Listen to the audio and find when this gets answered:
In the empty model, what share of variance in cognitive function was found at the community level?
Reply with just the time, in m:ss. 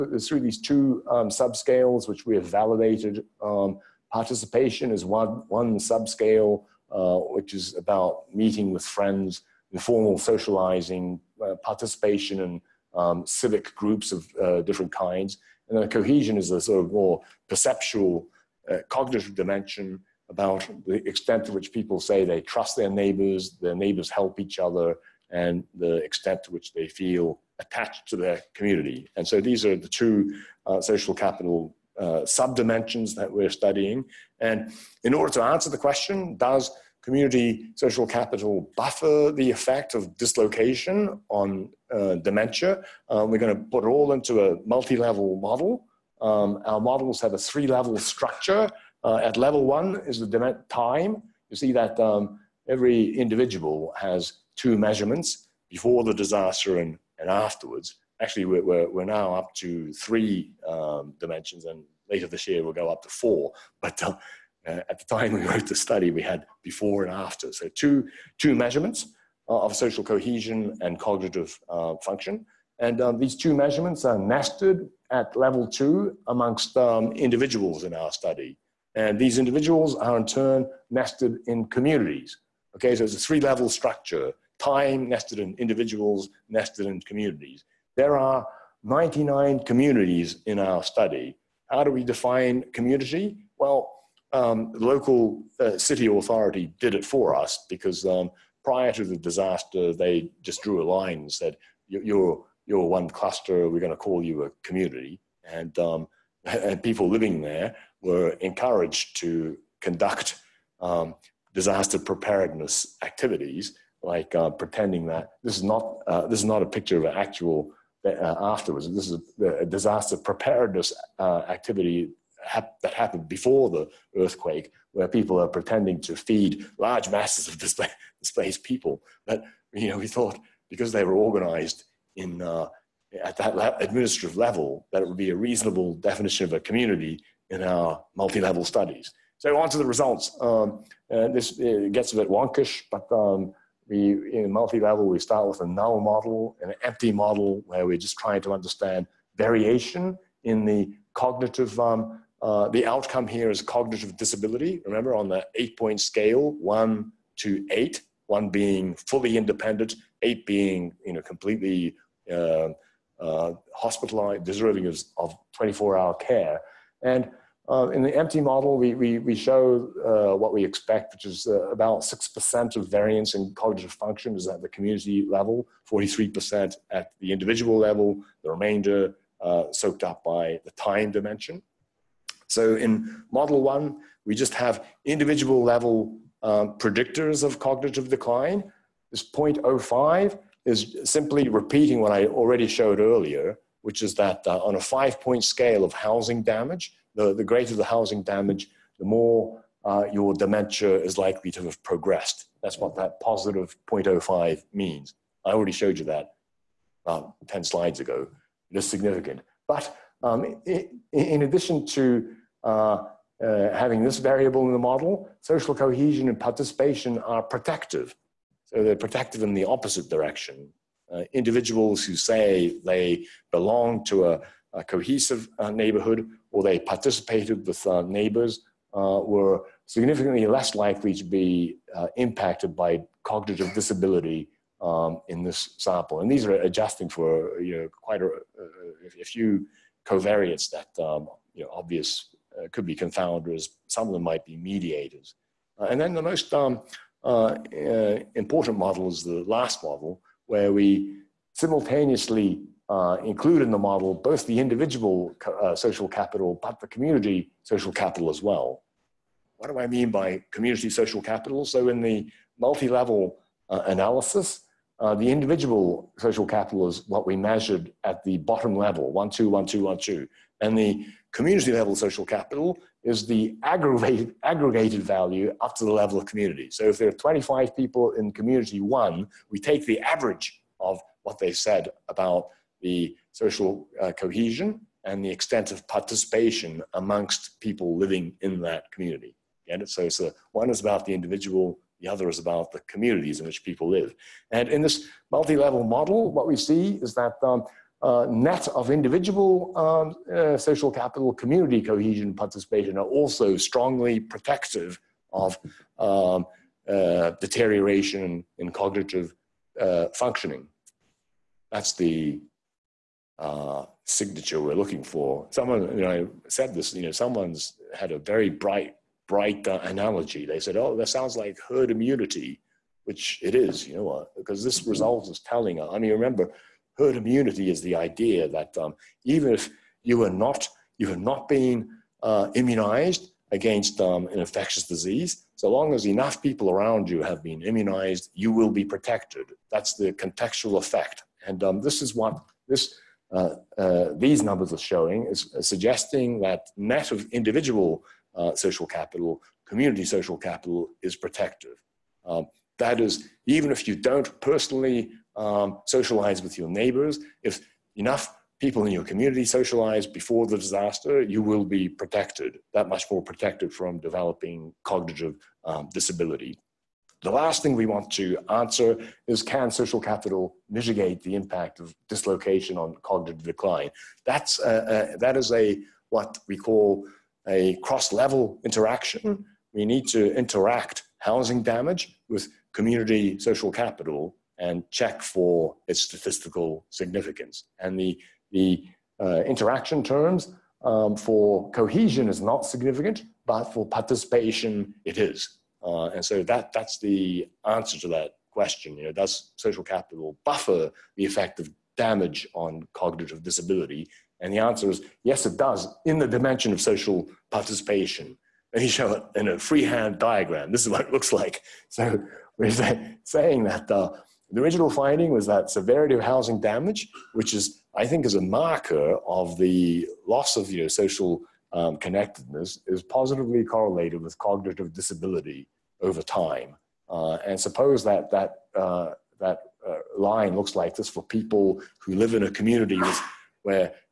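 2:51.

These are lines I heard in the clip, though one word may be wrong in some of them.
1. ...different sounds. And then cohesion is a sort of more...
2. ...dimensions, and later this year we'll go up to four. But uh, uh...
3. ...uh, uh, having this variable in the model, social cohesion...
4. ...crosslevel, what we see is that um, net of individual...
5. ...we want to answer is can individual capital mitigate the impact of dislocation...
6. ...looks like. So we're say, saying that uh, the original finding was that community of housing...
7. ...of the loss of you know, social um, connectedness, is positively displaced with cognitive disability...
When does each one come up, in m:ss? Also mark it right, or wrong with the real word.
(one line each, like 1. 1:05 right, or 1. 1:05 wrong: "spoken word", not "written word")
1. 0:14 wrong: "kinds", not "sounds"
2. 1:01 right
3. 3:32 right
4. 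4:55 wrong: "model", not "crosslevel"
5. 6:07 wrong: "social", not "individual"
6. 6:51 wrong: "severity", not "community"
7. 6:59 wrong: "correlated", not "displaced".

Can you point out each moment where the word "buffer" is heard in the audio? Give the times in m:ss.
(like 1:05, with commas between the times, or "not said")
0:38, 6:40.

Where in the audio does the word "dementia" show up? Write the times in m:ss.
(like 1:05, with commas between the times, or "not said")
0:42, 3:20.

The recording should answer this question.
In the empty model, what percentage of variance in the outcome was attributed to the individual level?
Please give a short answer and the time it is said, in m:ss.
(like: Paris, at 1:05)
43%, at 2:55.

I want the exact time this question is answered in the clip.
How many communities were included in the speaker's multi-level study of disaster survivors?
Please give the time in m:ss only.
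1:28.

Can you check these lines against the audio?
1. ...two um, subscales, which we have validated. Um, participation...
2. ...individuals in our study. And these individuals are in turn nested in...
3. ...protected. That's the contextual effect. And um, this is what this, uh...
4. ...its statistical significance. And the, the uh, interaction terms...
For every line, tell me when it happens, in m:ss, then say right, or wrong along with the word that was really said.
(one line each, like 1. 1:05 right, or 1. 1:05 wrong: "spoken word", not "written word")
1. 0:00 right
2. 1:17 right
3. 5:38 right
4. 6:25 right.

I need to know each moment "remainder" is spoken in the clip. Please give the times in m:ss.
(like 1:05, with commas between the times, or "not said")
2:58.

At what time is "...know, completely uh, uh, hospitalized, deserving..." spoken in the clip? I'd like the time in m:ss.
2:41.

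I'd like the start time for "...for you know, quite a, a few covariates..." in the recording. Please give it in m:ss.
3:57.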